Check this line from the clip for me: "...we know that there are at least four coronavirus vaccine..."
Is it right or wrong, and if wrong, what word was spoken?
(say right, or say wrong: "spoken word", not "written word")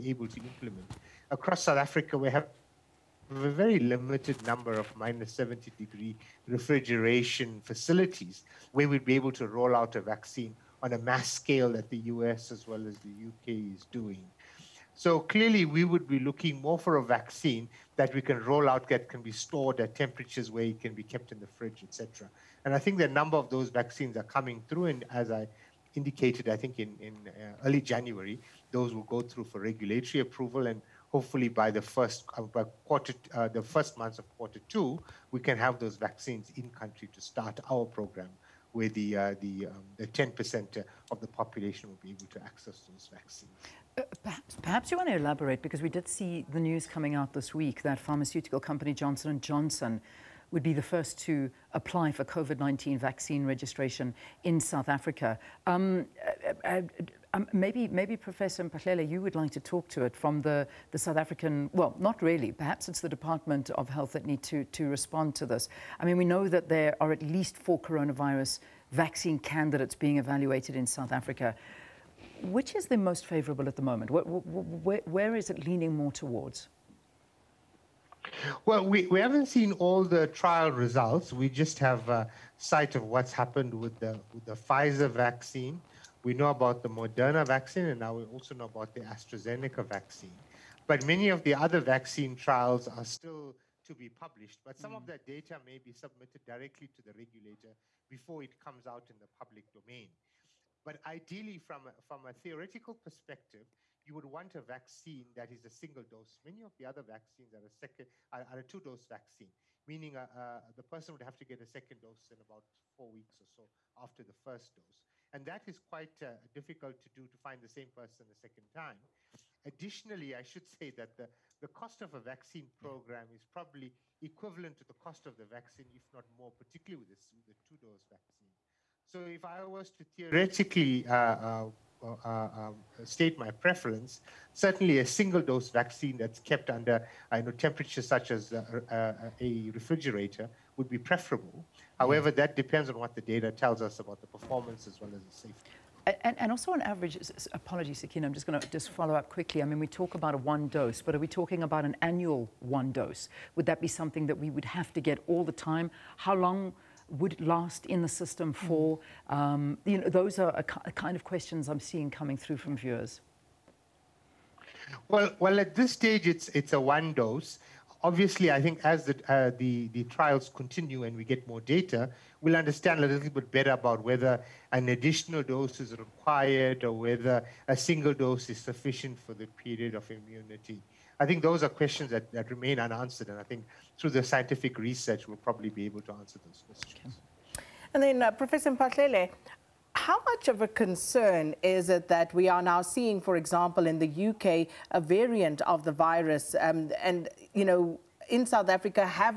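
right.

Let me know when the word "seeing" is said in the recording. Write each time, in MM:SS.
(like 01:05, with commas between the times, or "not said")
02:41, 03:12.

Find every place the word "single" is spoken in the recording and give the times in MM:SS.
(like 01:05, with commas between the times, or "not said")
01:45, 02:15, 02:57.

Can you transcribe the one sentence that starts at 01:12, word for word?
Which is the most favorable at the moment?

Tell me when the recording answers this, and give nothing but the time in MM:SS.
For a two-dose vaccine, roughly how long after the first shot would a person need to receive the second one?
01:52.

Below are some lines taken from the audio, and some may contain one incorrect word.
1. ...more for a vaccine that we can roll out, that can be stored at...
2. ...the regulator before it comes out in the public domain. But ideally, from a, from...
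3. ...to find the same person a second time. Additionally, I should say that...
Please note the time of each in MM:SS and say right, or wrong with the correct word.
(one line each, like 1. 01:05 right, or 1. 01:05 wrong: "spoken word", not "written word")
1. 00:16 right
2. 01:37 right
3. 01:57 right.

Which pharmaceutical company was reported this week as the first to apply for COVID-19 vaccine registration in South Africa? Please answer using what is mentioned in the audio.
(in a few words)
Johnson and Johnson.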